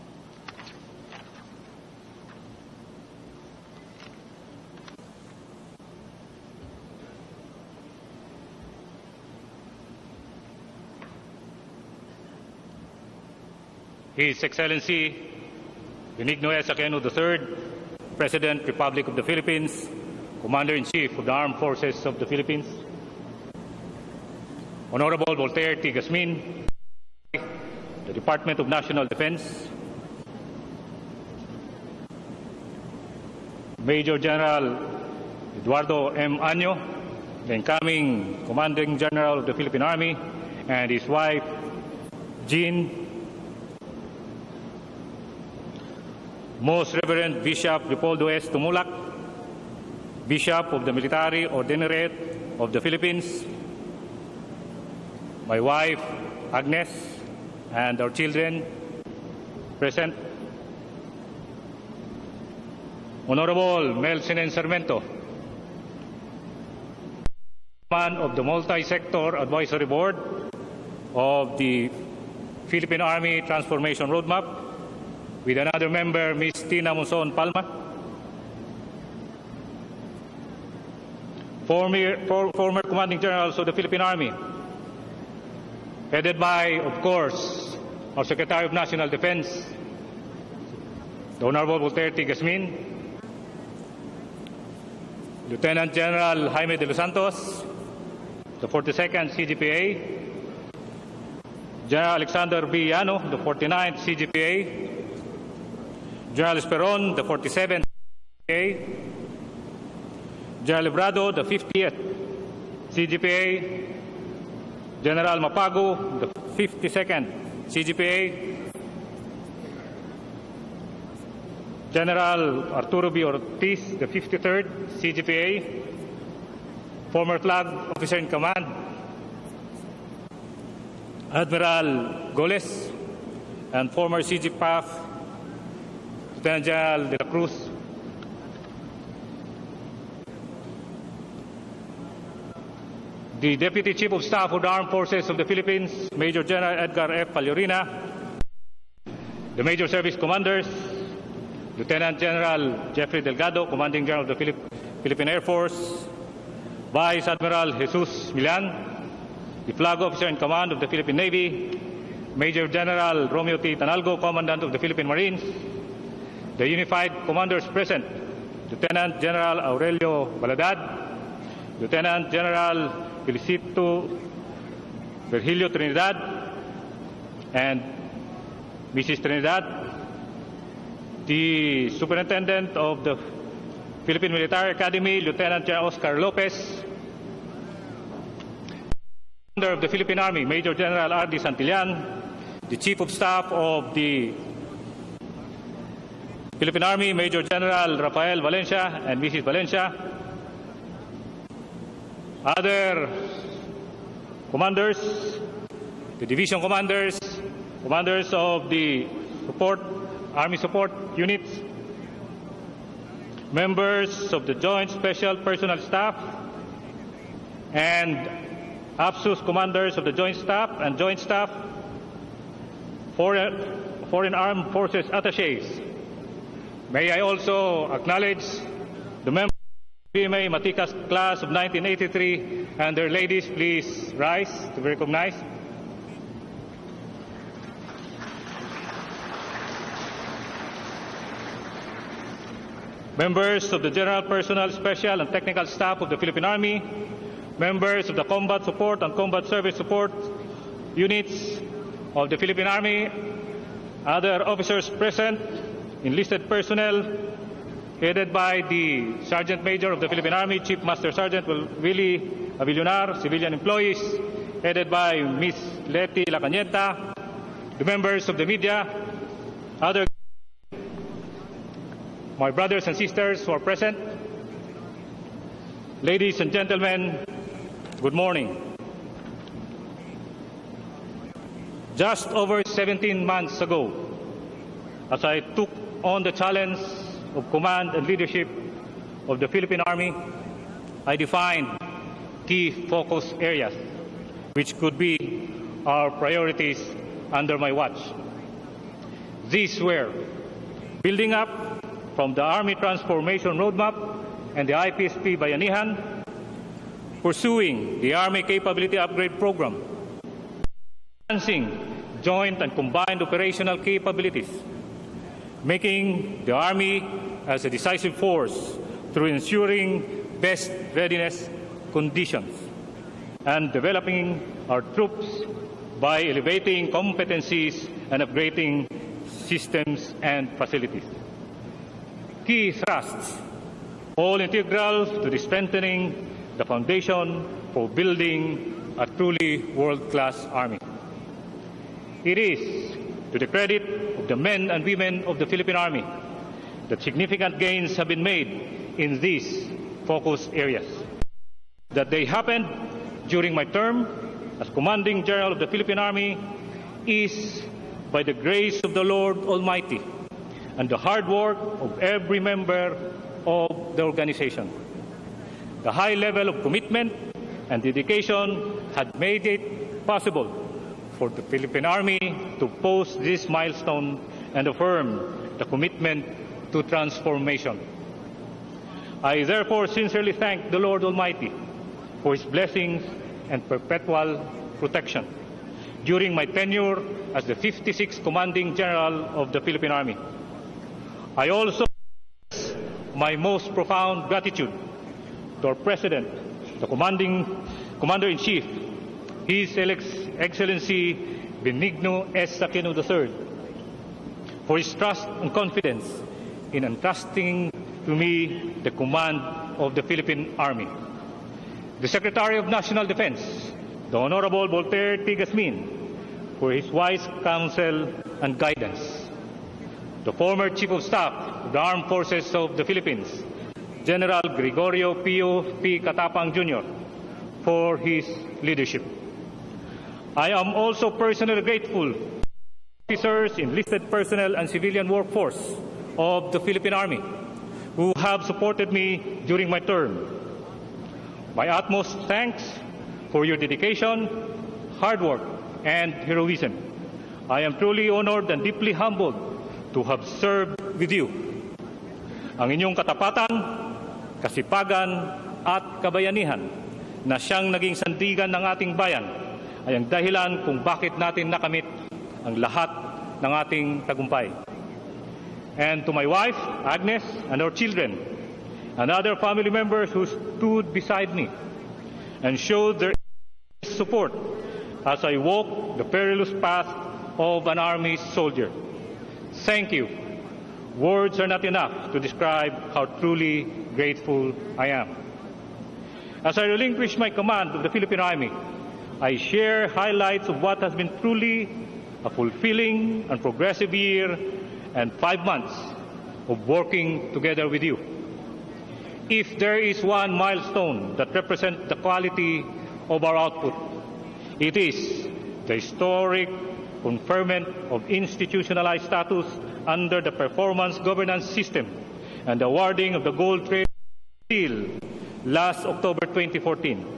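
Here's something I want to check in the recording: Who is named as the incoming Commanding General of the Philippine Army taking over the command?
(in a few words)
Eduardo M. Año.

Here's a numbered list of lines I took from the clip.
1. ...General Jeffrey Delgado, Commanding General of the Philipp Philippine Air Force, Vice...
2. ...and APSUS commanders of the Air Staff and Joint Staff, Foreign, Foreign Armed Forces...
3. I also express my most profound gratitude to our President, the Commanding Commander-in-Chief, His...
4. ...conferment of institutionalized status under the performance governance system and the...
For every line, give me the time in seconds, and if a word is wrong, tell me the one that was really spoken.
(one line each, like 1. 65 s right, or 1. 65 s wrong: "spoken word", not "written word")
1. 152 s right
2. 217 s wrong: "Joint", not "Air"
3. 391 s right
4. 507 s right.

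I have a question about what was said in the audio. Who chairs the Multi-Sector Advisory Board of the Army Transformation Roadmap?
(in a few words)
Melchinen Sarmiento.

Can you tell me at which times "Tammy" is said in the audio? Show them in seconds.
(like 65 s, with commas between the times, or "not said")
not said.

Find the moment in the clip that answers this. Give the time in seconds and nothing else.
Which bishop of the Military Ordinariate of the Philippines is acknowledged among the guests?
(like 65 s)
47 s.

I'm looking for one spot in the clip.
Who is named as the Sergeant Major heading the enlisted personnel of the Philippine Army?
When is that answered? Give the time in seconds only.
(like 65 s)
260 s.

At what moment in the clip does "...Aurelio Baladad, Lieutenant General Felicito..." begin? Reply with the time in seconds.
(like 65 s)
169 s.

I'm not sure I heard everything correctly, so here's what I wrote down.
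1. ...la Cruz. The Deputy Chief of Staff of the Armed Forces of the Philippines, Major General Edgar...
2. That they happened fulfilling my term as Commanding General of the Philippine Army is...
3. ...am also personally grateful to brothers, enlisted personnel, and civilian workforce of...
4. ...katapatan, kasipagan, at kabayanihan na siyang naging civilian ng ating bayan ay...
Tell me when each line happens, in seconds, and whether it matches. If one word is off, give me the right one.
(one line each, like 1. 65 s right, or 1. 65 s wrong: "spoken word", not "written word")
1. 137 s right
2. 351 s wrong: "during", not "fulfilling"
3. 430 s wrong: "officers", not "brothers"
4. 452 s wrong: "sandigan", not "civilian".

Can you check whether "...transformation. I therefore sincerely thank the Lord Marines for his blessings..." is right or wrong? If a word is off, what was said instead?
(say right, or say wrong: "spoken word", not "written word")
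wrong: "Almighty", not "Marines".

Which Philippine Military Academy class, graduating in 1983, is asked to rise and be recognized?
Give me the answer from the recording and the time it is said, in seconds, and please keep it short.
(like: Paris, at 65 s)
Matikas, at 230 s.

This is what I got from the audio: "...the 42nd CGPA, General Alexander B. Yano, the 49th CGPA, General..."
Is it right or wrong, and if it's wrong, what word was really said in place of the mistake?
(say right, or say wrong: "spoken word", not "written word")
right.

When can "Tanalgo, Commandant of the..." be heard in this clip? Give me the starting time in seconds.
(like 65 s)
163 s.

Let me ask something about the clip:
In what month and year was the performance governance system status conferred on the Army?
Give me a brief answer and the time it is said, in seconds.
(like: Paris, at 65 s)
October 2014, at 515 s.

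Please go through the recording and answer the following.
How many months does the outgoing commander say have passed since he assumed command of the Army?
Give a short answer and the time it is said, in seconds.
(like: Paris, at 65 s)
17, at 282 s.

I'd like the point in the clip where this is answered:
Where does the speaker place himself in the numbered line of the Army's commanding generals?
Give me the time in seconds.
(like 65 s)
387 s.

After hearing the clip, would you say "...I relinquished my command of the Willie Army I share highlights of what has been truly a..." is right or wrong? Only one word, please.
wrong.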